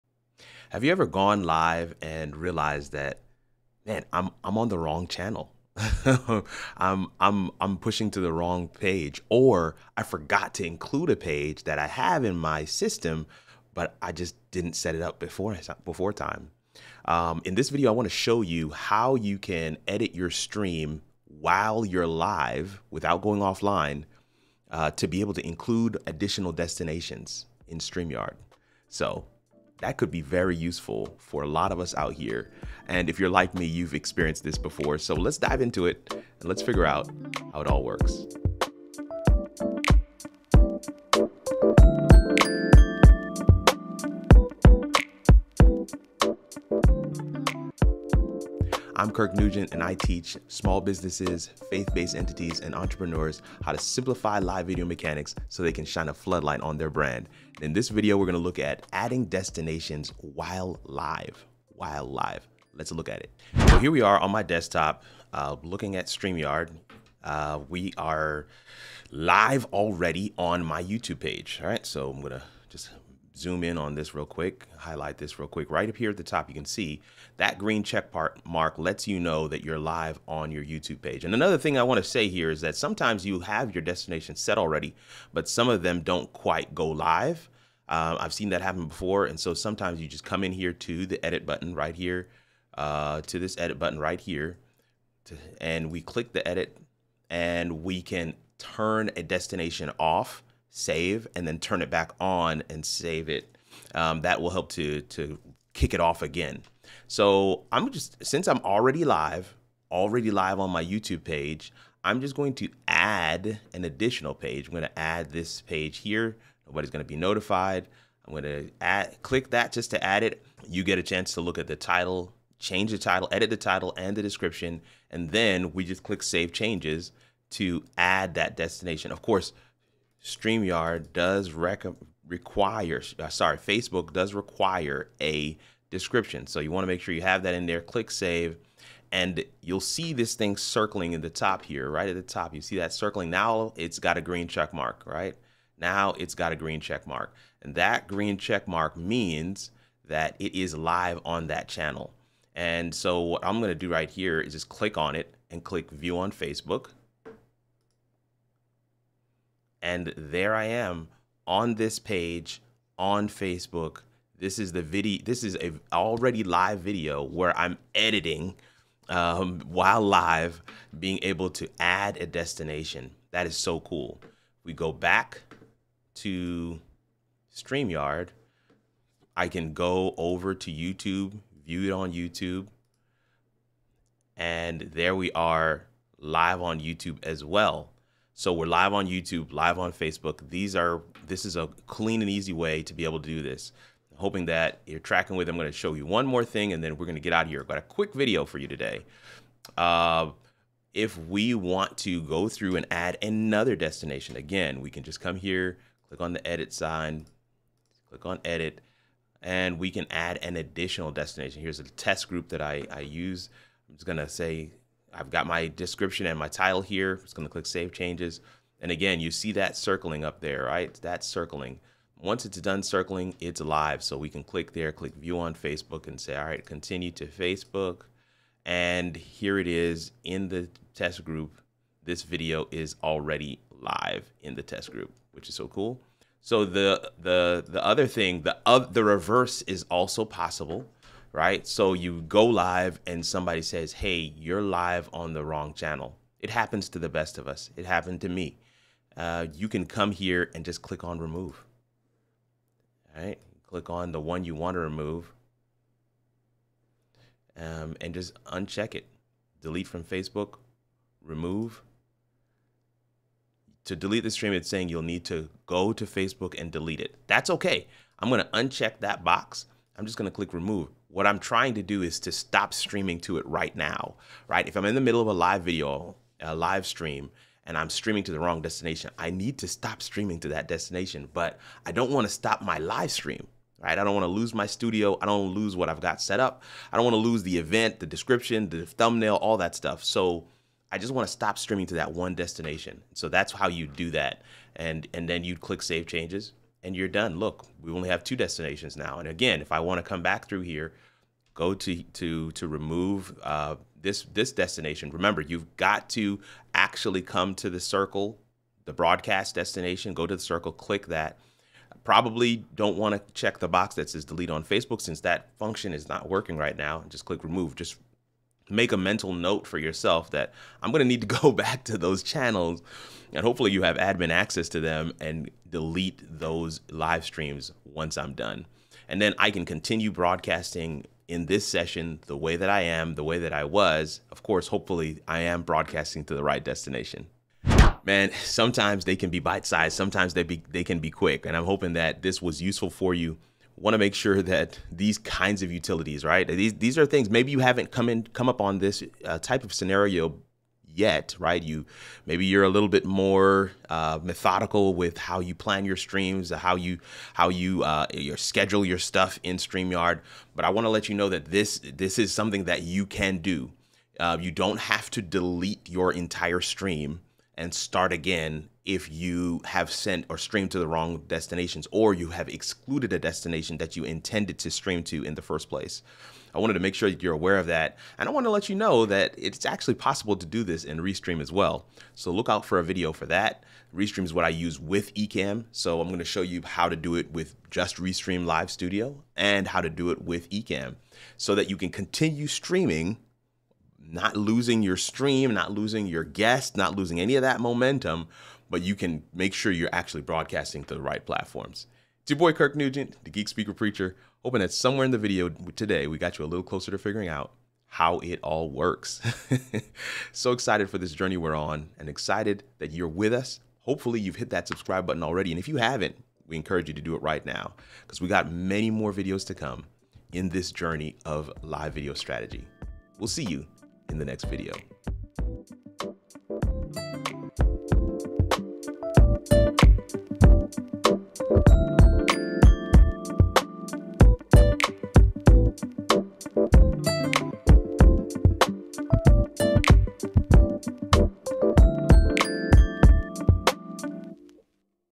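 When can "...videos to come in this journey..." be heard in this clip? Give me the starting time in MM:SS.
06:59.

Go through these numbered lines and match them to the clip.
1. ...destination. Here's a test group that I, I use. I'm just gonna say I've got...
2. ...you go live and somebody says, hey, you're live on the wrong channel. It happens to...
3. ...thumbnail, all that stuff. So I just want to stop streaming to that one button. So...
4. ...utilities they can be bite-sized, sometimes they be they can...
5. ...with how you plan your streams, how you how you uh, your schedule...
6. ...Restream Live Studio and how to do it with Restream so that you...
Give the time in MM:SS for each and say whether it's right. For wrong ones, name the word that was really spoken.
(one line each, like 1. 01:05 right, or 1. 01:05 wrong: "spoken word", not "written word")
1. 03:31 right
2. 04:01 right
3. 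04:48 wrong: "destination", not "button"
4. 05:38 wrong: "sometimes", not "utilities"
5. 05:54 right
6. 06:27 wrong: "Ecamm", not "Restream".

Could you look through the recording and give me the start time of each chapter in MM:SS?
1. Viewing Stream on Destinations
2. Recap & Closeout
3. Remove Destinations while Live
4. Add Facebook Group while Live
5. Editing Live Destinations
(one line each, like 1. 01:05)
1. 02:32
2. 05:37
3. 03:55
4. 03:18
5. 01:03.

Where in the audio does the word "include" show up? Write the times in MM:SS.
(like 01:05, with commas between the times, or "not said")
00:10, 00:25.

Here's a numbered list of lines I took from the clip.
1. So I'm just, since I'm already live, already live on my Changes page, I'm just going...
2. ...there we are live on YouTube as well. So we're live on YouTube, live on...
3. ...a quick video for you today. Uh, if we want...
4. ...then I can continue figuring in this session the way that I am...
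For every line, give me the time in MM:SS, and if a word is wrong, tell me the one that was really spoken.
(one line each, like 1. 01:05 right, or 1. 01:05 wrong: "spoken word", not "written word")
1. 01:47 wrong: "YouTube", not "Changes"
2. 03:04 right
3. 03:17 right
4. 05:29 wrong: "broadcasting", not "figuring".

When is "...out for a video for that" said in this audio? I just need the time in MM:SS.
06:22.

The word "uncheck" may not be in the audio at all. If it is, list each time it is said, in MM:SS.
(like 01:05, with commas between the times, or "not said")
04:18, 04:28.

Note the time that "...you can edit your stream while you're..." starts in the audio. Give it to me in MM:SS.
00:19.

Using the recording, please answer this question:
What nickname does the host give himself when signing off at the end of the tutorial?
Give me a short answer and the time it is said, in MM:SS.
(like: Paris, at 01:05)
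Geek Speaker Preacher, at 06:43.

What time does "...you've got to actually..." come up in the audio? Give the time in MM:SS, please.
05:05.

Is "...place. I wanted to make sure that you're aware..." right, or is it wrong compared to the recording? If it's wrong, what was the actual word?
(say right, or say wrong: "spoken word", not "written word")
right.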